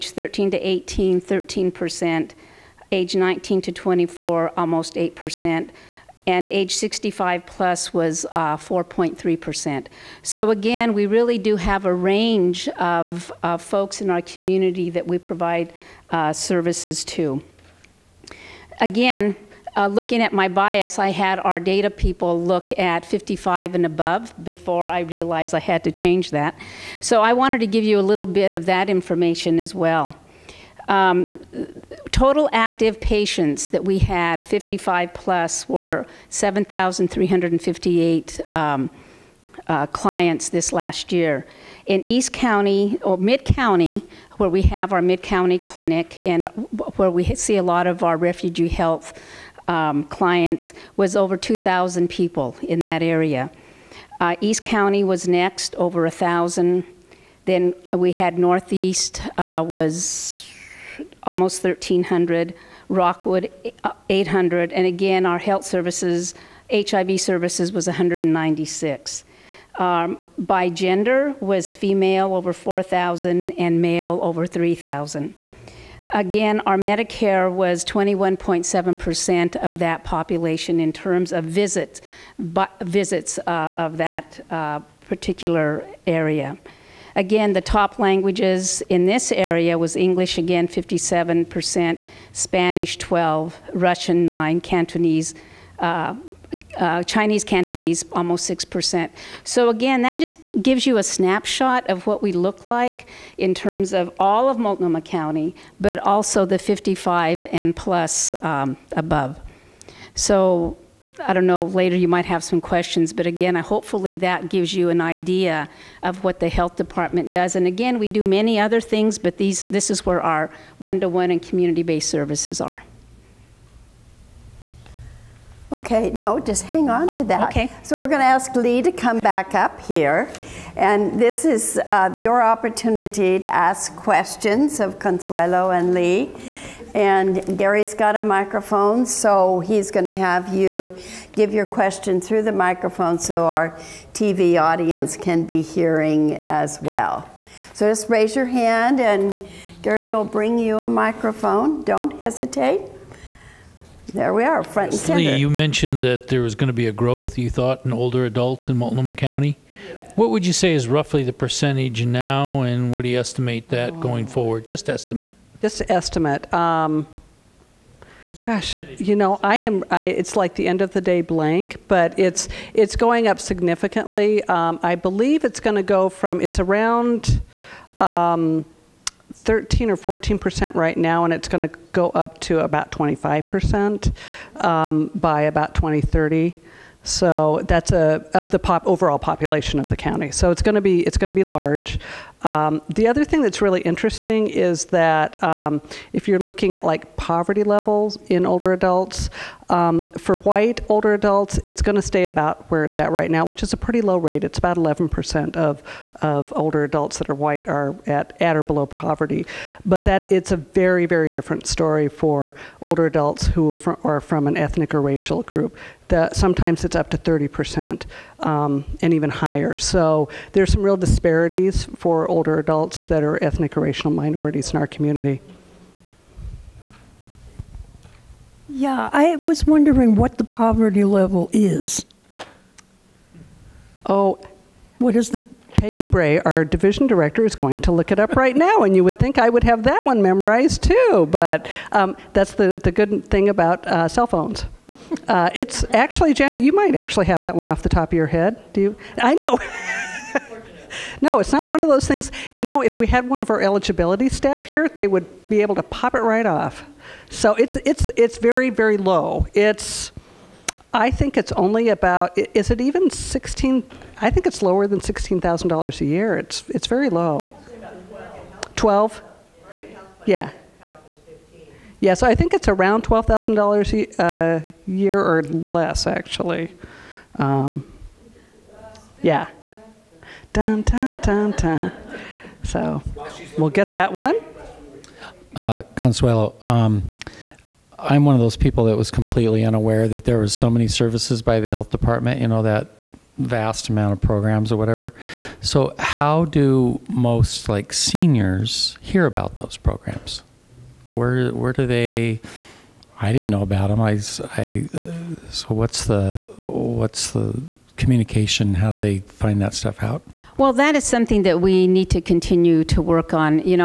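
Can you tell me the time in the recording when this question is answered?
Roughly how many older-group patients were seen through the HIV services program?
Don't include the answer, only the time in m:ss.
1:07.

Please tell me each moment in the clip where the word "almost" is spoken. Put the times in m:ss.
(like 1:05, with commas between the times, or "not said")
0:04, 1:01, 1:38.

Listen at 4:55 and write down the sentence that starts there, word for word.
So, how do most like seniors hear about those programs?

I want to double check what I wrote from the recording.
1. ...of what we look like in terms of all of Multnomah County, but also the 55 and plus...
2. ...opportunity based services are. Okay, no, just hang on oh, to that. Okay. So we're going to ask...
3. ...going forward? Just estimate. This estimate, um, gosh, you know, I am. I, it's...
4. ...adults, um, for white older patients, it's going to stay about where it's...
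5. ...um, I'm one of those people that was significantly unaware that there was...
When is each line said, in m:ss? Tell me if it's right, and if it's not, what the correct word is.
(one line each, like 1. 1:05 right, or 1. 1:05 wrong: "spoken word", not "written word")
1. 1:41 right
2. 2:01 wrong: "community", not "opportunity"
3. 2:43 right
4. 3:18 wrong: "adults", not "patients"
5. 4:46 wrong: "completely", not "significantly".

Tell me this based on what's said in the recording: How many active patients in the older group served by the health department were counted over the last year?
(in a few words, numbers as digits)
7,358.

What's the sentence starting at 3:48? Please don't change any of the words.
Yeah, I was wondering what the poverty level is.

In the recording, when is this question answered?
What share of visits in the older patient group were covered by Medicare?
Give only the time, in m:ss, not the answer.
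1:17.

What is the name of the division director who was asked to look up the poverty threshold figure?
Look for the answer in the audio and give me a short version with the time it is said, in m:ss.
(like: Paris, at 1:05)
Peggy Bray, at 3:55.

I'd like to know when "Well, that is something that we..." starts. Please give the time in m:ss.
5:10.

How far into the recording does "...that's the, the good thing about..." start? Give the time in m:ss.
4:02.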